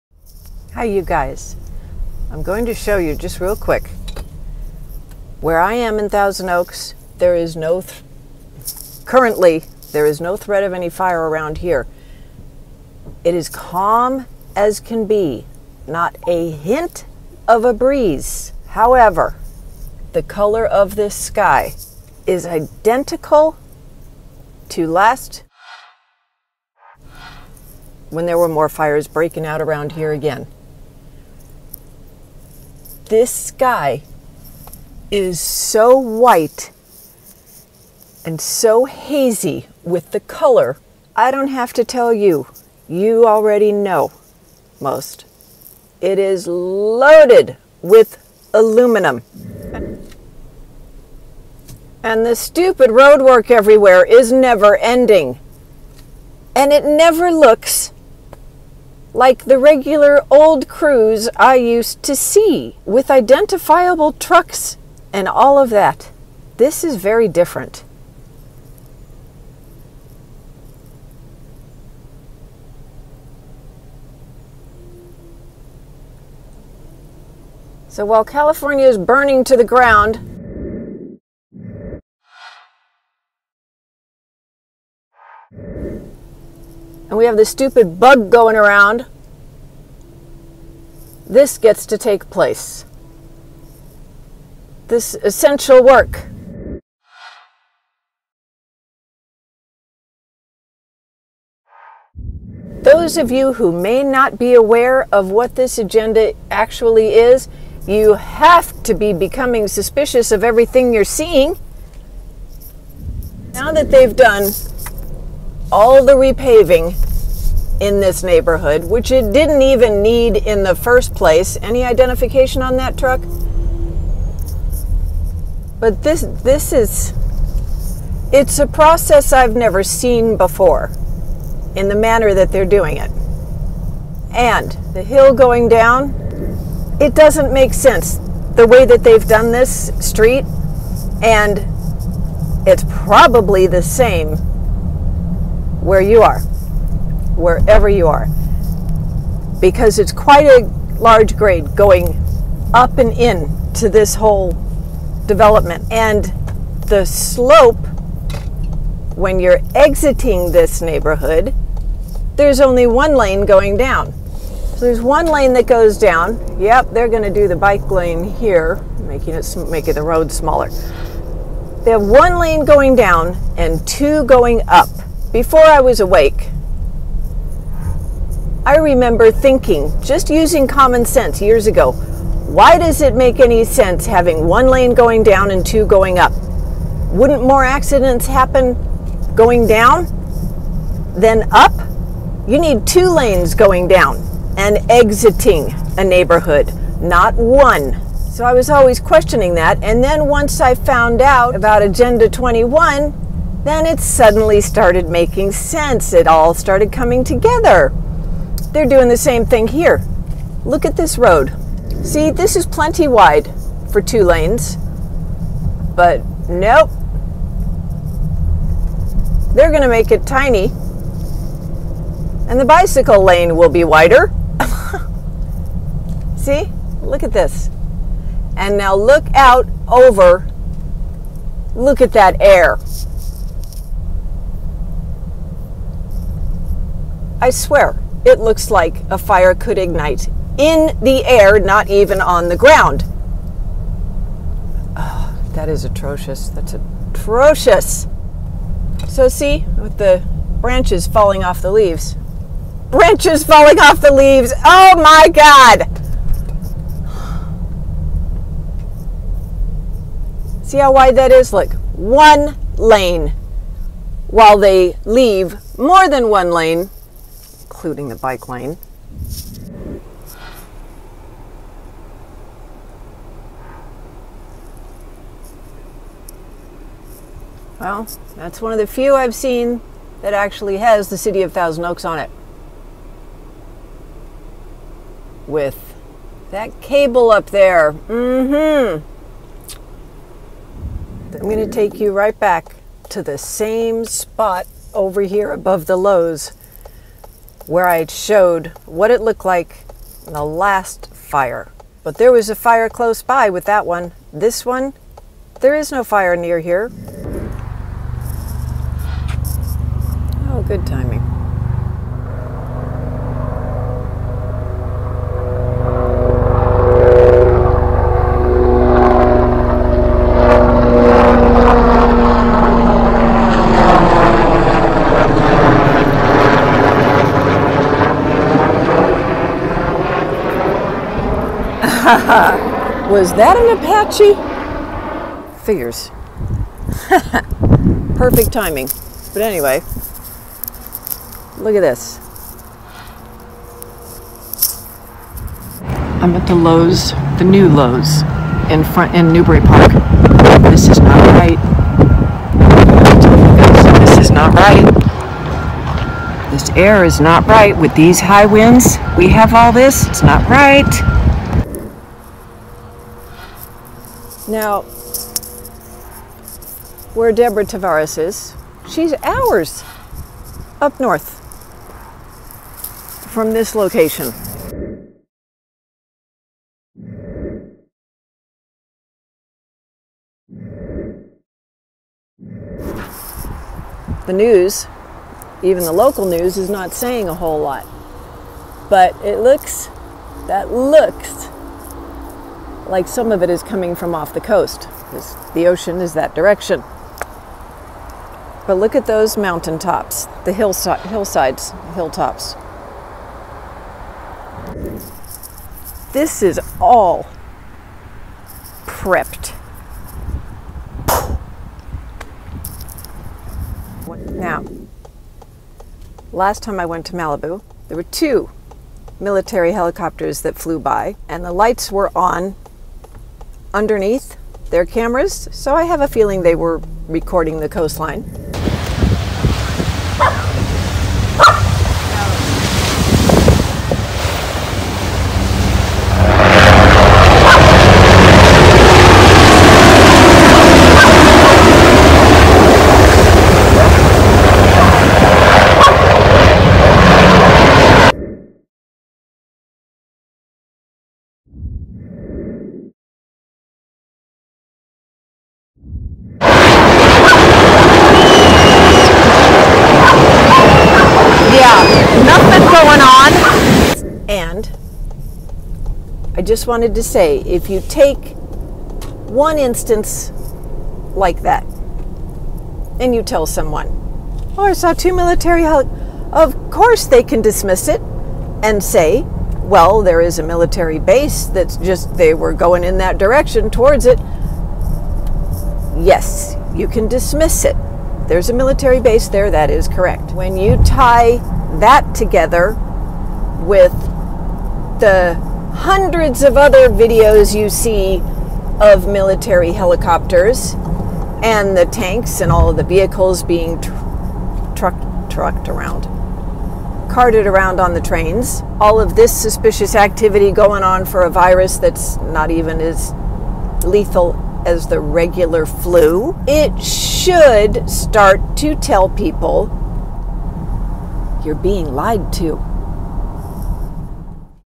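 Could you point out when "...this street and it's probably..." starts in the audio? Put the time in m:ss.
2:19.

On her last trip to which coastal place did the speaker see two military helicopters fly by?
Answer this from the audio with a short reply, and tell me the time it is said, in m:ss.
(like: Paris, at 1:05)
Malibu, at 6:57.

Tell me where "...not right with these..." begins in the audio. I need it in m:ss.
5:57.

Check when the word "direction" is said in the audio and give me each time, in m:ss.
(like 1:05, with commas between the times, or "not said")
6:36, 8:03.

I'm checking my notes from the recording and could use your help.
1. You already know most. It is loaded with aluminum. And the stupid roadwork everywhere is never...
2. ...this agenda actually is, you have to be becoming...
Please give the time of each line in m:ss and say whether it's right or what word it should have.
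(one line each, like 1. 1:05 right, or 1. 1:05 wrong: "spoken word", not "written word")
1. 0:42 right
2. 1:45 right.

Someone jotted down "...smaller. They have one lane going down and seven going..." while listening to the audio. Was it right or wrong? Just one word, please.
wrong.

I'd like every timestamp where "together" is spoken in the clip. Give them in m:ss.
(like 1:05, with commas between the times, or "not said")
3:27, 8:12.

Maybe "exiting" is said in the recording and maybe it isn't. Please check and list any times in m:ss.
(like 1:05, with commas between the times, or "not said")
2:39, 3:14.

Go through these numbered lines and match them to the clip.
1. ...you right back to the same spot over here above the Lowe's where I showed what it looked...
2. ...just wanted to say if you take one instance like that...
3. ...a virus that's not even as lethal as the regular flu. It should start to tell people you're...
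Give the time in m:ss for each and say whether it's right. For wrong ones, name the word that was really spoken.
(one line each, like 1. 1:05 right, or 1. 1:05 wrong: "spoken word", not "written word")
1. 4:51 right
2. 7:46 right
3. 8:31 right.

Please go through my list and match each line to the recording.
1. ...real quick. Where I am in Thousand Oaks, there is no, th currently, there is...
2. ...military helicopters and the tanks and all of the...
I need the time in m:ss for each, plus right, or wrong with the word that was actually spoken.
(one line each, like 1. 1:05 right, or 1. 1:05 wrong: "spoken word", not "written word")
1. 0:03 right
2. 8:19 right.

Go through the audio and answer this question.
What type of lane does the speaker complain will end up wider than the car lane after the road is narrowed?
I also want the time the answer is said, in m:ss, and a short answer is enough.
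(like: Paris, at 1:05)
Bicycle lane, at 3:42.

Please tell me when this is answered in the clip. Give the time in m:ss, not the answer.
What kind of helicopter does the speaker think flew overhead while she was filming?
5:33.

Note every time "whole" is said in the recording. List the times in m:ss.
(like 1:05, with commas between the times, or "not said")
2:34, 6:27.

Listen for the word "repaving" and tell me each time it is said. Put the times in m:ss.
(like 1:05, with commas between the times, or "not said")
1:56.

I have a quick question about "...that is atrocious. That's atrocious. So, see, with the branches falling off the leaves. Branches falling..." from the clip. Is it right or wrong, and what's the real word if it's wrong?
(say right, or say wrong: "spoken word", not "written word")
right.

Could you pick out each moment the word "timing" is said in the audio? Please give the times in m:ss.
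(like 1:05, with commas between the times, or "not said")
5:10, 5:38.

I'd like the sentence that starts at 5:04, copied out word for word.
This one, there is no fire near here.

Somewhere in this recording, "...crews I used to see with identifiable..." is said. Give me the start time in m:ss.
1:00.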